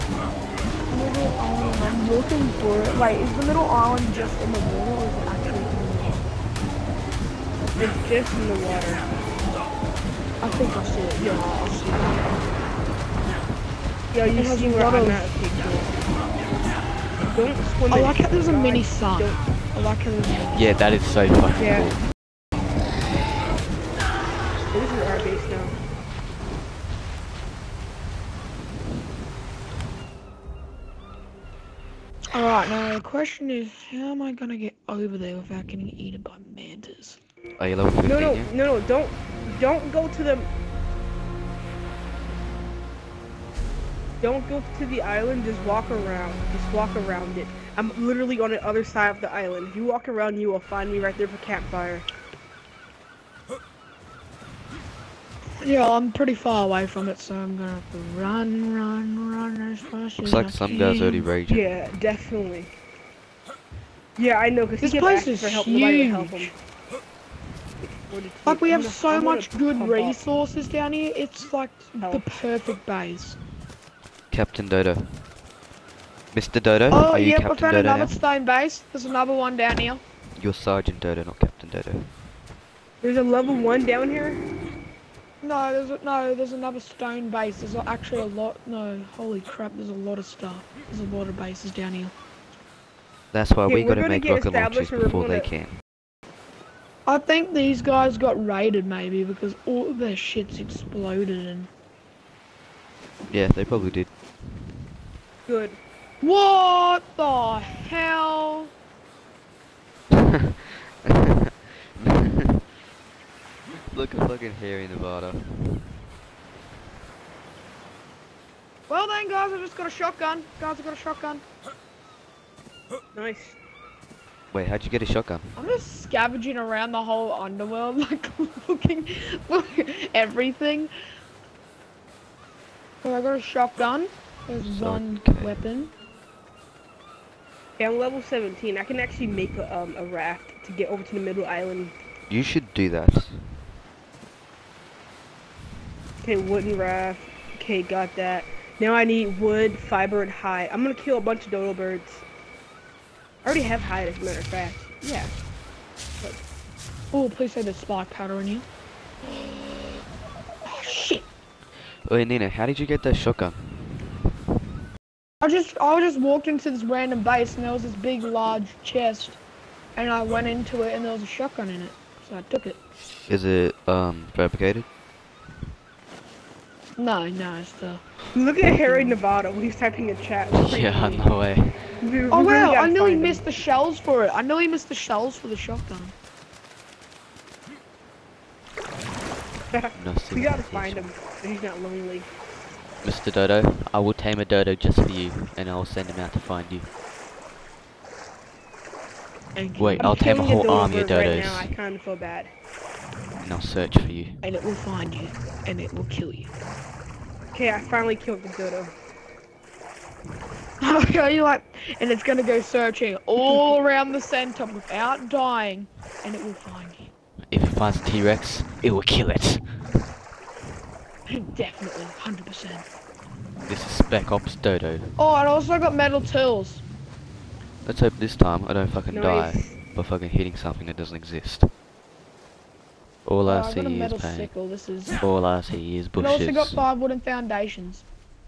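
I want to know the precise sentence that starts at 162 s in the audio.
Wait, Nina, how did you get that shotgun?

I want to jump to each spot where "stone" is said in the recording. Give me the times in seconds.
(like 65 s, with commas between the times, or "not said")
78 s, 86 s.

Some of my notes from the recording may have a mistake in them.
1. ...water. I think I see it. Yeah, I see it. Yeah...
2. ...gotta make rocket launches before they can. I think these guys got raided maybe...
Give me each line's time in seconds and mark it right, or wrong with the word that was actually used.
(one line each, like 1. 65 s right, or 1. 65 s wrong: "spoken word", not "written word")
1. 8 s right
2. 94 s right.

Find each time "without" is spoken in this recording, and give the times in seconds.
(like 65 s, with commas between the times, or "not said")
35 s, 214 s.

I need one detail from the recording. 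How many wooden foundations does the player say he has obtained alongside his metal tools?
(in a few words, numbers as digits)
5.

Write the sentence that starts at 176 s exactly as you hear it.
No, no, it's Look at Harry Nevada when he's typing a chat.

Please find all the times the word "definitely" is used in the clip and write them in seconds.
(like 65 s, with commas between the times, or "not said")
61 s, 221 s.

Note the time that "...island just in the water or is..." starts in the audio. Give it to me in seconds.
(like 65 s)
3 s.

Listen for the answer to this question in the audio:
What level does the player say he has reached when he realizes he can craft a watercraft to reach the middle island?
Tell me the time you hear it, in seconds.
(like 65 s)
137 s.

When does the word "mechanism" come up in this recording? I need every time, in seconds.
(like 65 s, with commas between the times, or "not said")
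not said.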